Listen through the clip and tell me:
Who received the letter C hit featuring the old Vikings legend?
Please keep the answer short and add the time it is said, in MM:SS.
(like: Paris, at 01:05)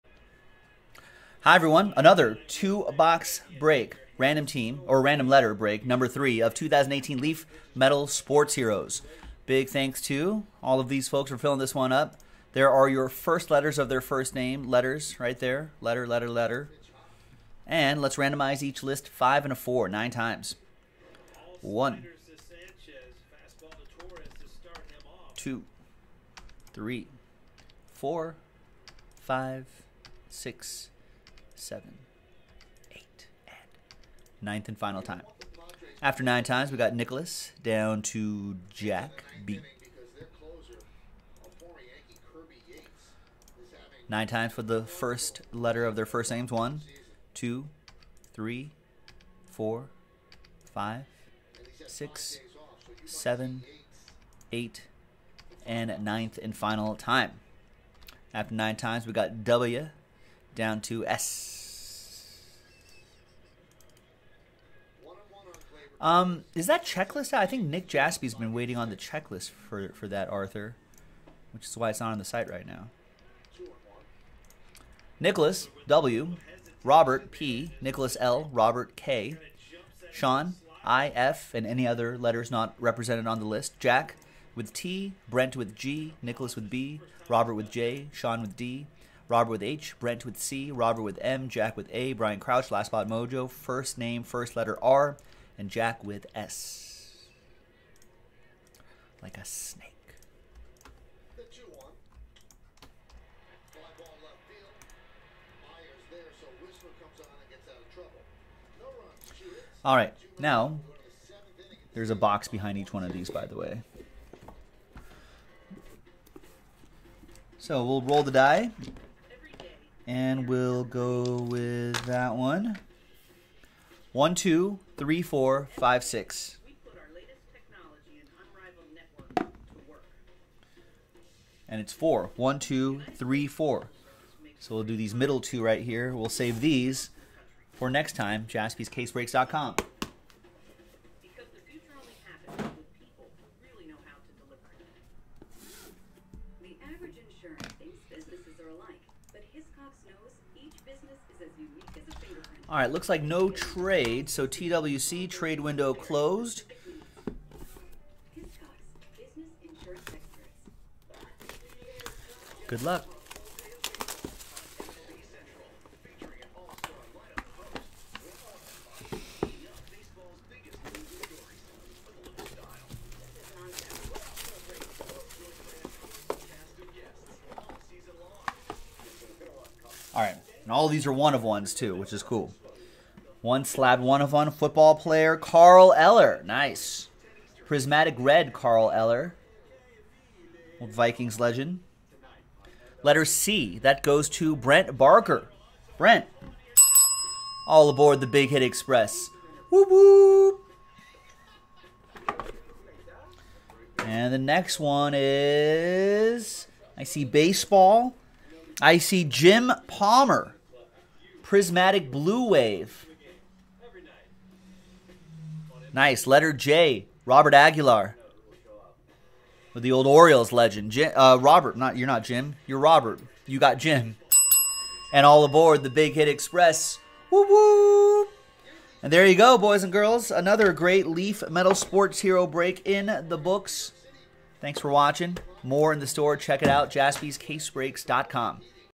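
Brent Barker, at 03:14.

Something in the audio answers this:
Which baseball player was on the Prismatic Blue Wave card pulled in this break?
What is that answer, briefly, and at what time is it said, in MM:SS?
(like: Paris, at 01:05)
Jim Palmer, at 03:29.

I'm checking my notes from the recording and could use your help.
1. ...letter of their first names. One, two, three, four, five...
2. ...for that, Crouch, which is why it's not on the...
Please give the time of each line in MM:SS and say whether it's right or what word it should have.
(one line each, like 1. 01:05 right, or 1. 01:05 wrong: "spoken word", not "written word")
1. 00:45 right
2. 01:09 wrong: "Arthur", not "Crouch".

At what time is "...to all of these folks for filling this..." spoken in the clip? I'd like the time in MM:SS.
00:10.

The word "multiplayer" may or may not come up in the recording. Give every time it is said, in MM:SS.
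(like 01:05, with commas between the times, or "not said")
not said.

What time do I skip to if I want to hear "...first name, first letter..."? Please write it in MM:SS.
01:33.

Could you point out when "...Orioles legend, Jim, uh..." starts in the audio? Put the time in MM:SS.
03:40.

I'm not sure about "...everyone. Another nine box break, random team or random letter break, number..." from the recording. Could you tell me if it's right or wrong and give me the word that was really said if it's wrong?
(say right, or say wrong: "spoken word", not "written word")
wrong: "two", not "nine".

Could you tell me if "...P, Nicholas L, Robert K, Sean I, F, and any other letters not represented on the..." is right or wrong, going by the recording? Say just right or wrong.
right.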